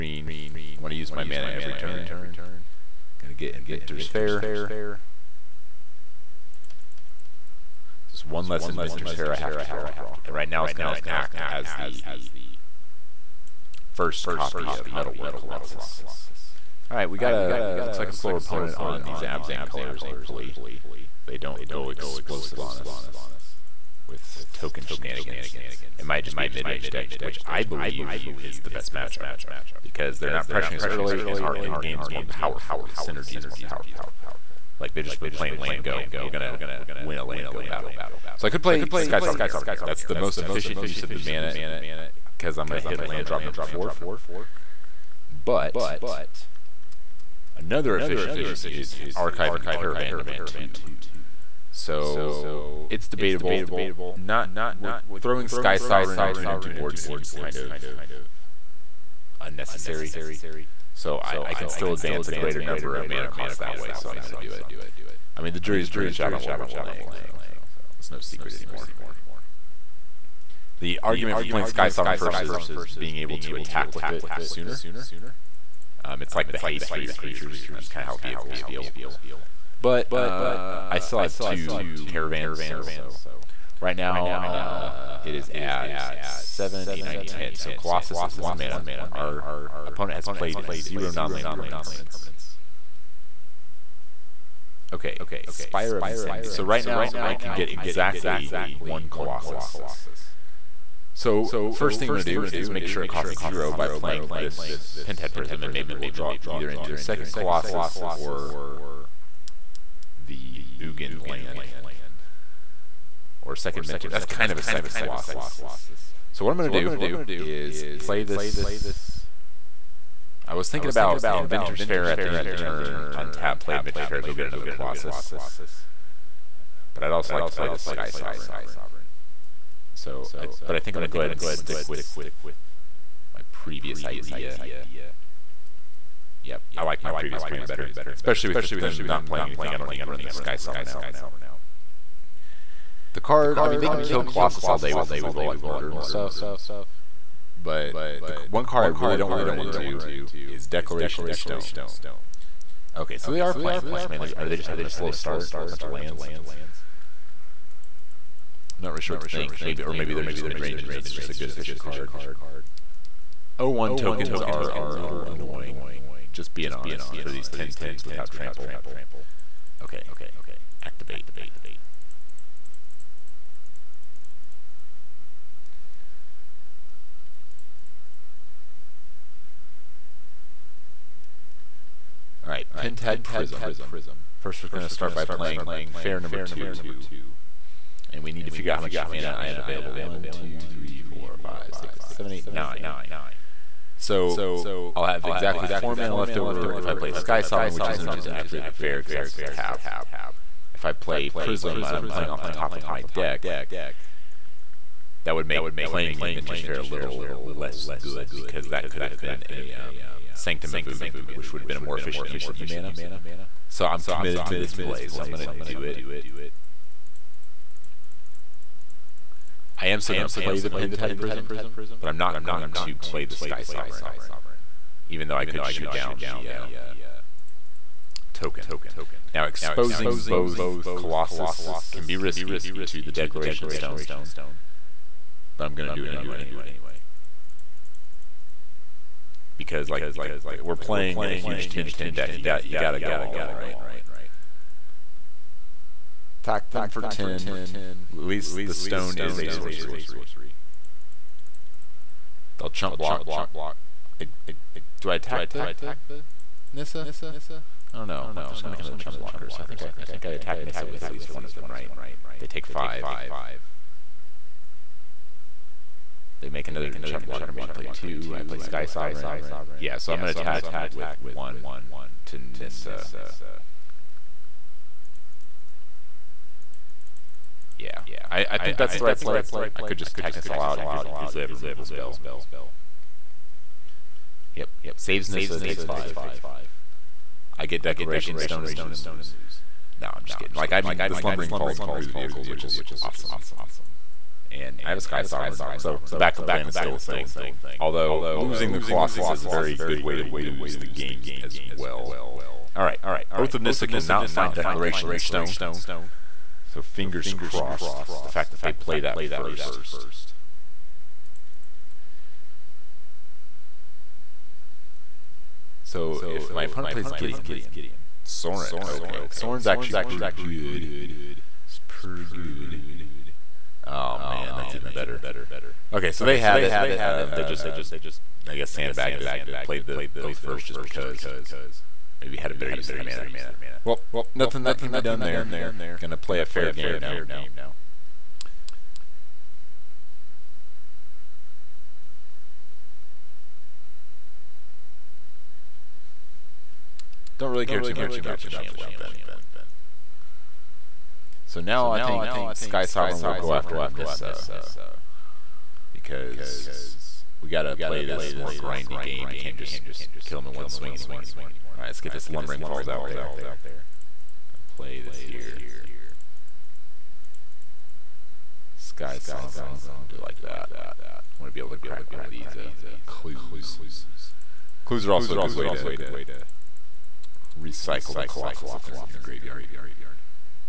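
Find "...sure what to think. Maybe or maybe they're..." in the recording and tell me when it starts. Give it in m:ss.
2:39.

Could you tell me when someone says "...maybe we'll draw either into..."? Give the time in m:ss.
1:45.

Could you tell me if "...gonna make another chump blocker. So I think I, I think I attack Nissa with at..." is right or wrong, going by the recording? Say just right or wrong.
right.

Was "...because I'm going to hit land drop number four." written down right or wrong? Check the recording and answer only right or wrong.
right.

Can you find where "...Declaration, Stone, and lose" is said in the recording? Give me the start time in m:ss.
4:47.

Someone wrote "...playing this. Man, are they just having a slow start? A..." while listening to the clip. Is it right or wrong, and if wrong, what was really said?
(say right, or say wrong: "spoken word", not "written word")
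right.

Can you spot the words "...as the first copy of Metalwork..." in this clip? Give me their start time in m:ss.
0:11.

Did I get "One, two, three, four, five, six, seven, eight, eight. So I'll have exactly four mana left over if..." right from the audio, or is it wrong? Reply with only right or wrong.
wrong.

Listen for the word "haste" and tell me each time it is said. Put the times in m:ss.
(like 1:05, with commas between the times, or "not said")
1:16.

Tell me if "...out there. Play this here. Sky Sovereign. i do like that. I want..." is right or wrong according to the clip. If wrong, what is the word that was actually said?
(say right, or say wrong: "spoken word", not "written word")
right.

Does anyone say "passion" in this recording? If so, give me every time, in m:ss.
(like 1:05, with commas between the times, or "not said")
not said.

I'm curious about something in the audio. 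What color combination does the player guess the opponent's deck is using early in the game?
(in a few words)
Abzan.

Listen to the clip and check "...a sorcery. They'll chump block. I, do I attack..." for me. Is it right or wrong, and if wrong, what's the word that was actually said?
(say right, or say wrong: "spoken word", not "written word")
right.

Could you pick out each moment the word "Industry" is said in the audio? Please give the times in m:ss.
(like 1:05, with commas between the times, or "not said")
1:36.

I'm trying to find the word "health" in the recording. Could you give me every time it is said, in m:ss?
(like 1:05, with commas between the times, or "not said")
not said.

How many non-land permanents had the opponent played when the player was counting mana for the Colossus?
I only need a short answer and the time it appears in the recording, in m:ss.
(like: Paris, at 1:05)
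0, at 1:30.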